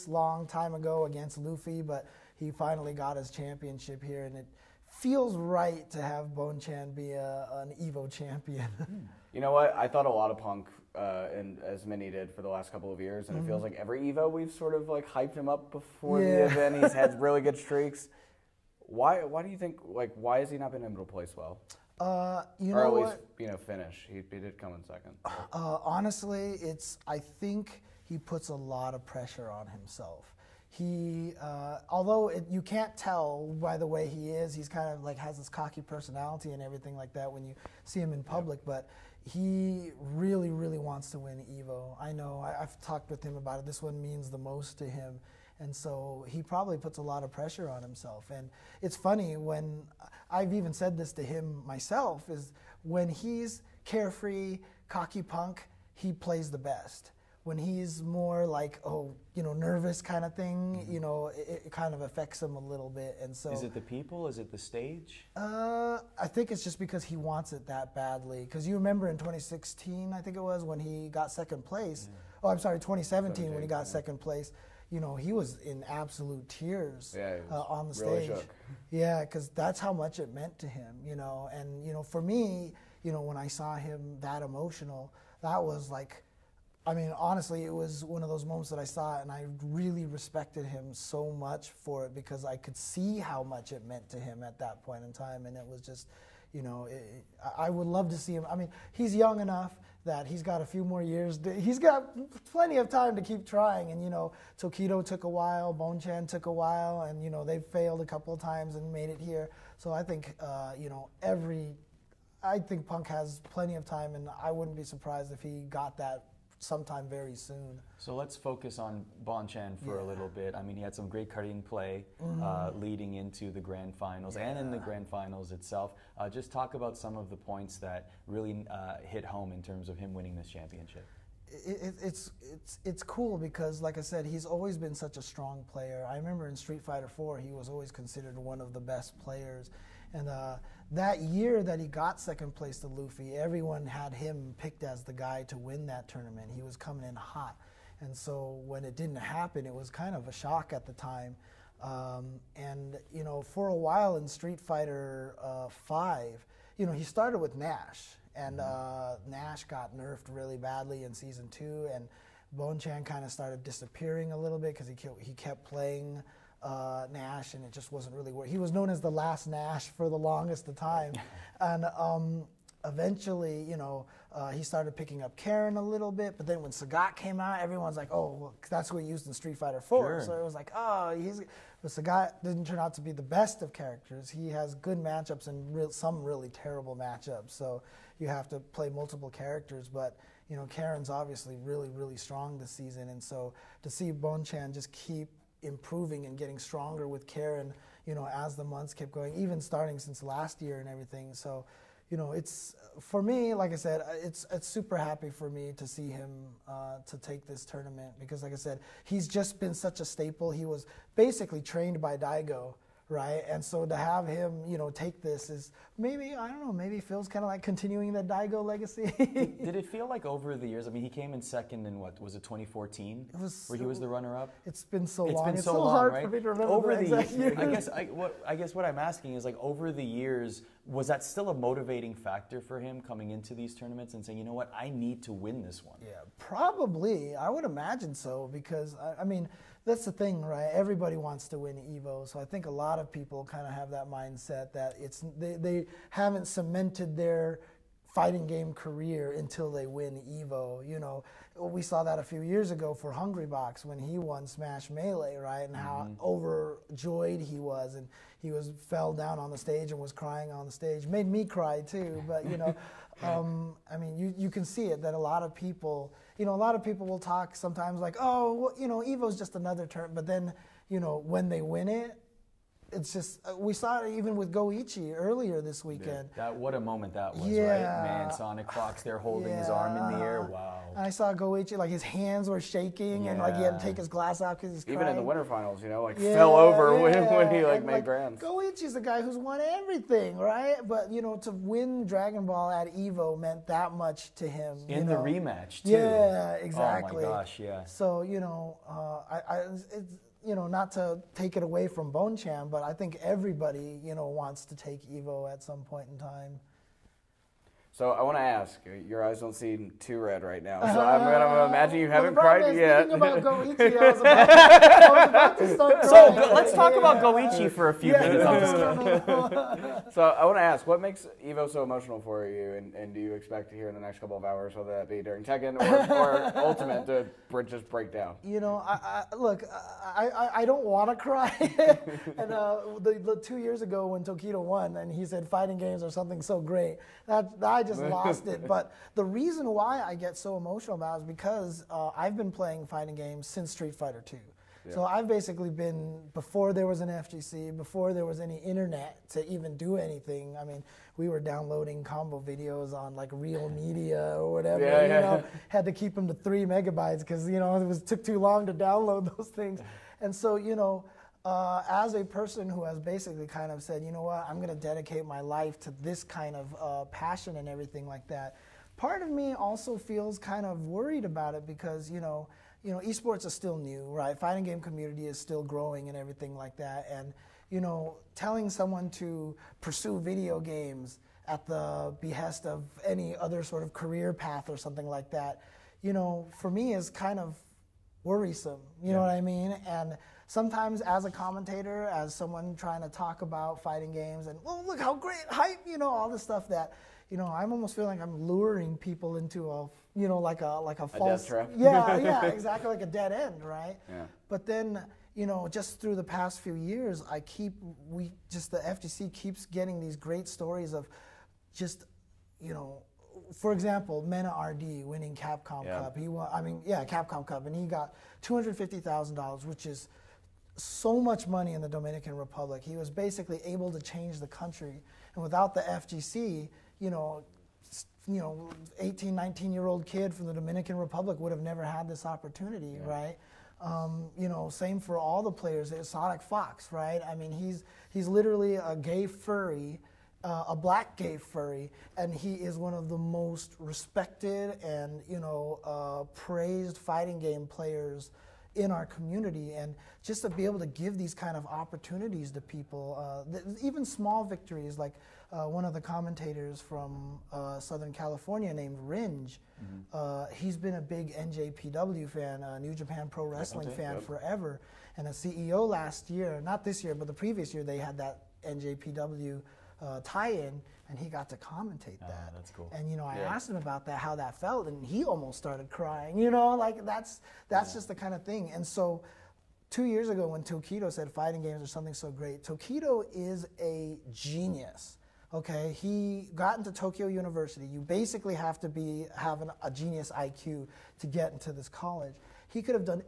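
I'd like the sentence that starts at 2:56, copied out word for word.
But then when Sagat came out, everyone's like, "Oh, well, that's what he used in Street Fighter 4.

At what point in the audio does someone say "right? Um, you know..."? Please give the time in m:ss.
7:13.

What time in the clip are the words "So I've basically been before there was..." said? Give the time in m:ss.
5:44.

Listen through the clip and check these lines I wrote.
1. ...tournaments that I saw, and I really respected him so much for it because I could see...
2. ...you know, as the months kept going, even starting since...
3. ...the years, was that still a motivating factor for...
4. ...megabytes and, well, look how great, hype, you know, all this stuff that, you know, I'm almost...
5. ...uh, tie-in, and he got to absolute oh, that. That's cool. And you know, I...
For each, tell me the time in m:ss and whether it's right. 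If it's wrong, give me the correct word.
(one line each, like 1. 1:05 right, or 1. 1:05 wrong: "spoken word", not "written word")
1. 1:28 wrong: "moments", not "tournaments"
2. 3:18 right
3. 3:49 right
4. 6:34 wrong: "games", not "megabytes"
5. 7:50 wrong: "commentate", not "absolute".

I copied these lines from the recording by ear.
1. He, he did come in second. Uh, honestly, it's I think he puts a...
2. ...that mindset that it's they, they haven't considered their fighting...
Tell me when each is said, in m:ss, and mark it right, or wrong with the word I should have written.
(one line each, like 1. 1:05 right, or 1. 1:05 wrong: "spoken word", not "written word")
1. 0:24 right
2. 4:03 wrong: "cemented", not "considered".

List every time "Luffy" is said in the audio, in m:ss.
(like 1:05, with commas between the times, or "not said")
0:01, 2:22.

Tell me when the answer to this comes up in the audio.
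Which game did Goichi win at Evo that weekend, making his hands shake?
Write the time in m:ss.
4:52.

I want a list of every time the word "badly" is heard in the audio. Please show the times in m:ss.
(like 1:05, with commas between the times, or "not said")
1:07, 2:40.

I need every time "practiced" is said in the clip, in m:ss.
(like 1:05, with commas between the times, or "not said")
not said.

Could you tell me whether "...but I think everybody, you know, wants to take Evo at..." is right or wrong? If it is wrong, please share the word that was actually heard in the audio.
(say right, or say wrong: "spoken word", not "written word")
right.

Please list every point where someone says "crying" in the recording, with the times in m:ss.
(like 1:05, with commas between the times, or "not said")
4:20, 4:44, 7:55.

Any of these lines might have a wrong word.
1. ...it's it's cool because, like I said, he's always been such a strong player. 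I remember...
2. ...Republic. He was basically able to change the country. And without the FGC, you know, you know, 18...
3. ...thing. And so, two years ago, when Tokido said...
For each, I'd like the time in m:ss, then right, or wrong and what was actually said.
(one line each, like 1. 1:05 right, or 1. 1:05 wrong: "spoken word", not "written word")
1. 2:12 right
2. 7:02 right
3. 7:58 right.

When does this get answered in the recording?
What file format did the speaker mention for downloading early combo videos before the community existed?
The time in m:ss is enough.
5:53.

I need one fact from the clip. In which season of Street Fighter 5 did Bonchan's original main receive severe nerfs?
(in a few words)
season two.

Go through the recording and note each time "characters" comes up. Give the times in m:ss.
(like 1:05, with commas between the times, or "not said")
3:03, 3:09.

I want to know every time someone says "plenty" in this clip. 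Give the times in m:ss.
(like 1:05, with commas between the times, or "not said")
1:42, 1:53.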